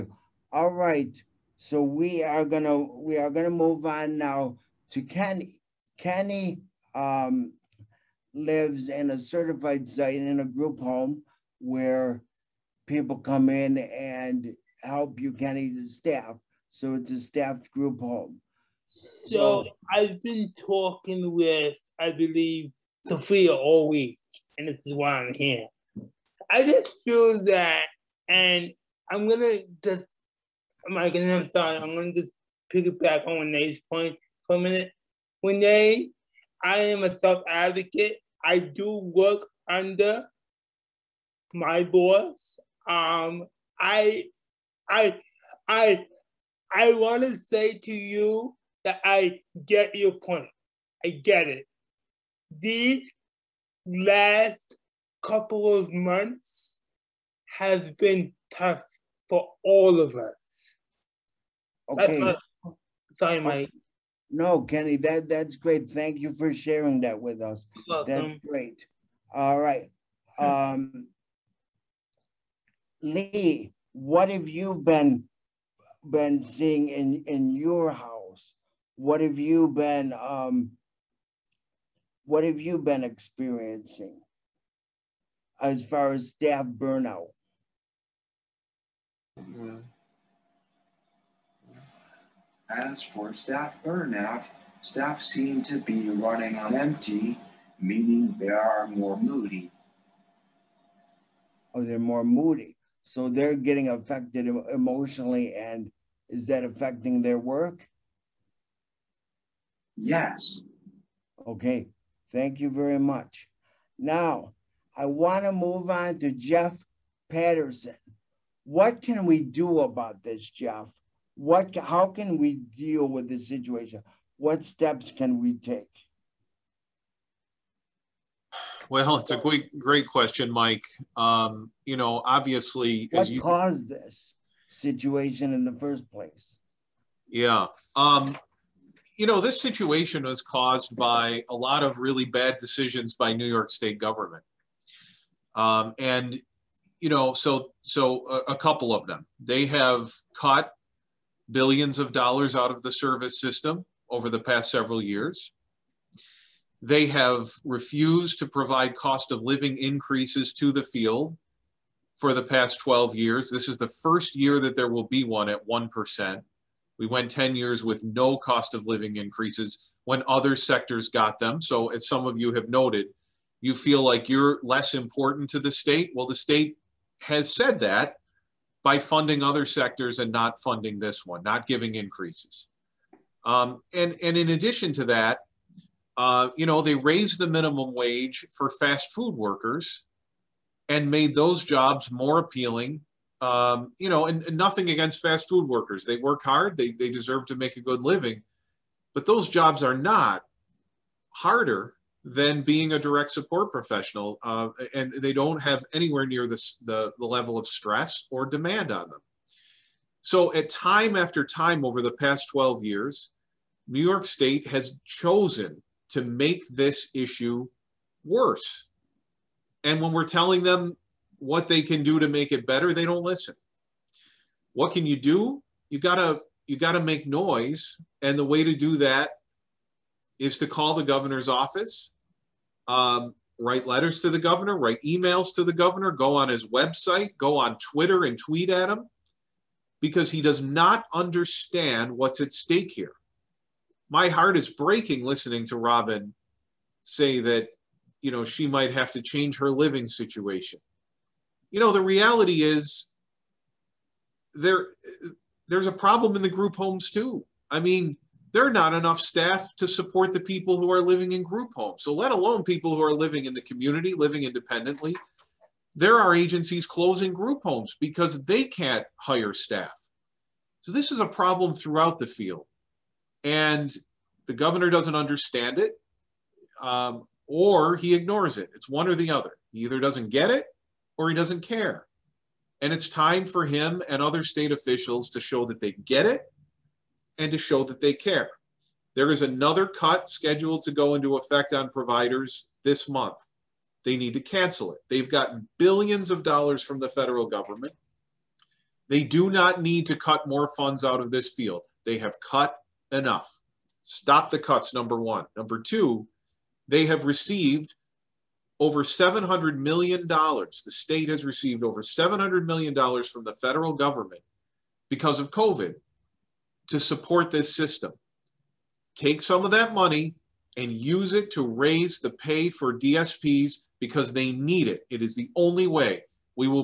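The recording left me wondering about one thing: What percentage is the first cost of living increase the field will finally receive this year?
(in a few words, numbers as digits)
1%.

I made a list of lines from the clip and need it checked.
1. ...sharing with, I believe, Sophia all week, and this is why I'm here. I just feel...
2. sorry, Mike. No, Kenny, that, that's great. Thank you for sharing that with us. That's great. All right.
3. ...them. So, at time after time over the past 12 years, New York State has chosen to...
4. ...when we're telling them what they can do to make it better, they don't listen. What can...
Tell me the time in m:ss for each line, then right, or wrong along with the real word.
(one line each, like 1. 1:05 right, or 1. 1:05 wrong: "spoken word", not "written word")
1. 0:20 wrong: "talking", not "sharing"
2. 1:03 right
3. 3:29 right
4. 3:40 right.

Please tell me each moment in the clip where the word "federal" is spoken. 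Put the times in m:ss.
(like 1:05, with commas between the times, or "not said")
4:57, 5:13.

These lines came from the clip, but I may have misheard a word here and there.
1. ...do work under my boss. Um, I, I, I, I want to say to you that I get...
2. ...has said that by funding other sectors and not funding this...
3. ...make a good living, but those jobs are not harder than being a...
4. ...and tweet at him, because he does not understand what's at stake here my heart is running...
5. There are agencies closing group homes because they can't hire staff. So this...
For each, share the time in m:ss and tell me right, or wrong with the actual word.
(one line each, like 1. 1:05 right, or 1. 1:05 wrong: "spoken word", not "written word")
1. 0:38 right
2. 2:57 right
3. 3:17 right
4. 3:58 wrong: "breaking", not "running"
5. 4:25 right.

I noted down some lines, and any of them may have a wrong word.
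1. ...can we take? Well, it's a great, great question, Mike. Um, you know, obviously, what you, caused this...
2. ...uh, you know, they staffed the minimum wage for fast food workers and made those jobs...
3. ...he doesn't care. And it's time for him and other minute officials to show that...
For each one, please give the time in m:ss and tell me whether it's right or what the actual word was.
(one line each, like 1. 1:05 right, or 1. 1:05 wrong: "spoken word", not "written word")
1. 2:05 right
2. 3:06 wrong: "raised", not "staffed"
3. 4:41 wrong: "state", not "minute".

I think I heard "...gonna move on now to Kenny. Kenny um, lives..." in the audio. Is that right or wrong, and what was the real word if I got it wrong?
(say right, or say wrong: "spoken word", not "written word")
right.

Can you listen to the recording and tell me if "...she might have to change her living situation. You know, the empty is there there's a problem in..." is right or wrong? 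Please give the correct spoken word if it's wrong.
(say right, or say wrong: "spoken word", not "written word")
wrong: "reality", not "empty".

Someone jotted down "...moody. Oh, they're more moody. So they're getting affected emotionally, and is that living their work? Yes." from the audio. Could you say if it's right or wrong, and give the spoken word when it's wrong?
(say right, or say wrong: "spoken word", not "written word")
wrong: "affecting", not "living".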